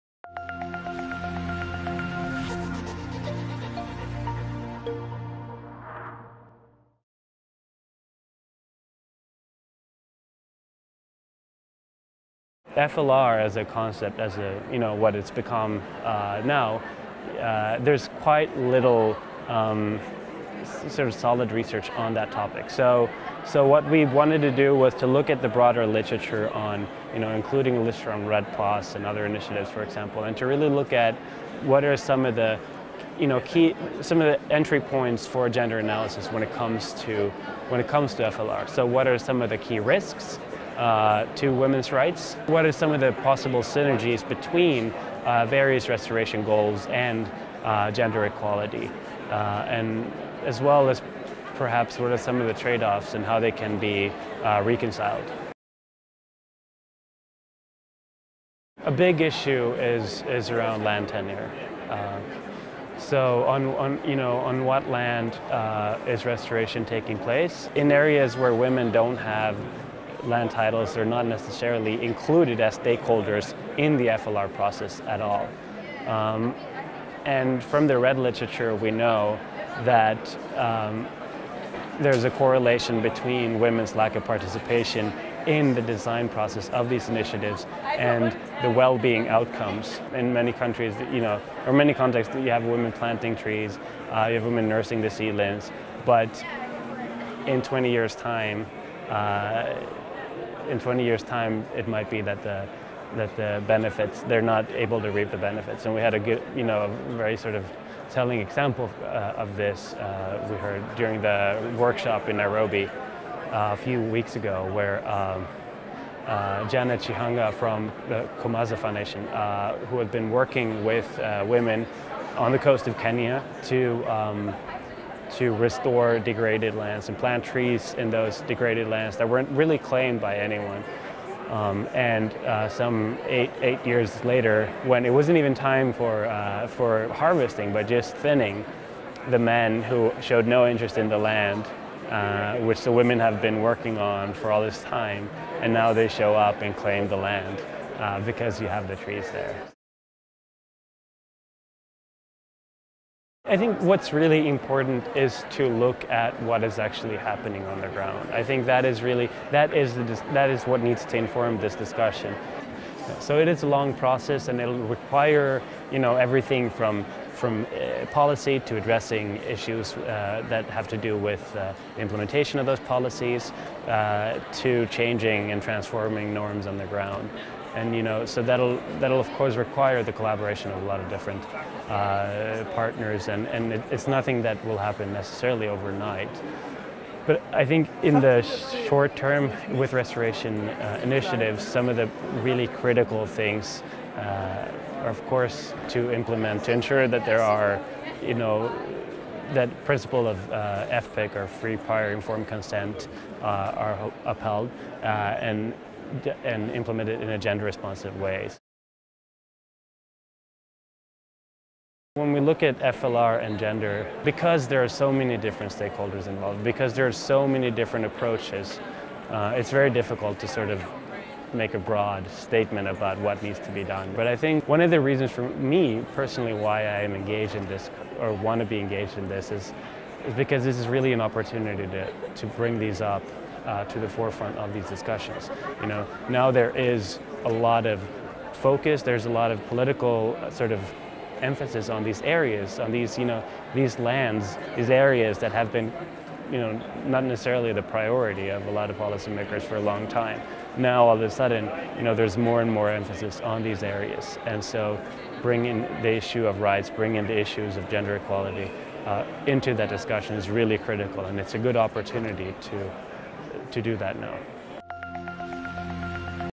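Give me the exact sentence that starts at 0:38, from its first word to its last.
So, what are some of the key risks uh, to women's rights?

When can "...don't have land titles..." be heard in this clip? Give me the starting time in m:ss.
1:08.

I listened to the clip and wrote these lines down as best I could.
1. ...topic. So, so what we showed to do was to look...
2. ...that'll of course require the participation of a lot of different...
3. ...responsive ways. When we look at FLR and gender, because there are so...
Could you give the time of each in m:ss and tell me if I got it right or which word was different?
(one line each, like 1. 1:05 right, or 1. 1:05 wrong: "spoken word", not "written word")
1. 0:22 wrong: "wanted", not "showed"
2. 2:59 wrong: "collaboration", not "participation"
3. 3:27 right.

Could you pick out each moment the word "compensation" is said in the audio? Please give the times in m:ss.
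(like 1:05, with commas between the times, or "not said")
not said.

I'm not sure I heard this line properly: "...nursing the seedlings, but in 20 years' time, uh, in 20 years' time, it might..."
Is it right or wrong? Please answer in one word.
right.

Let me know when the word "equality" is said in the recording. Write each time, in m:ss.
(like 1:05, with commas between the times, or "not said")
0:48, 4:18.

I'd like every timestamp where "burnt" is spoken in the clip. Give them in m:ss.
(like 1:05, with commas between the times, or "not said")
not said.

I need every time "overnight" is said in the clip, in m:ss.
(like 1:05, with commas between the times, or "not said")
3:05.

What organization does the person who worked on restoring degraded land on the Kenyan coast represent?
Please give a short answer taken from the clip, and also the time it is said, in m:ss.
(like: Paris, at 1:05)
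Komaza Foundation, at 1:58.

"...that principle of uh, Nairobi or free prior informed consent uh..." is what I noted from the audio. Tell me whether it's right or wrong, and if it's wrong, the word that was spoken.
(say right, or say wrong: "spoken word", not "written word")
wrong: "FPIC", not "Nairobi".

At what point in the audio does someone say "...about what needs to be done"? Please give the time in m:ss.
3:42.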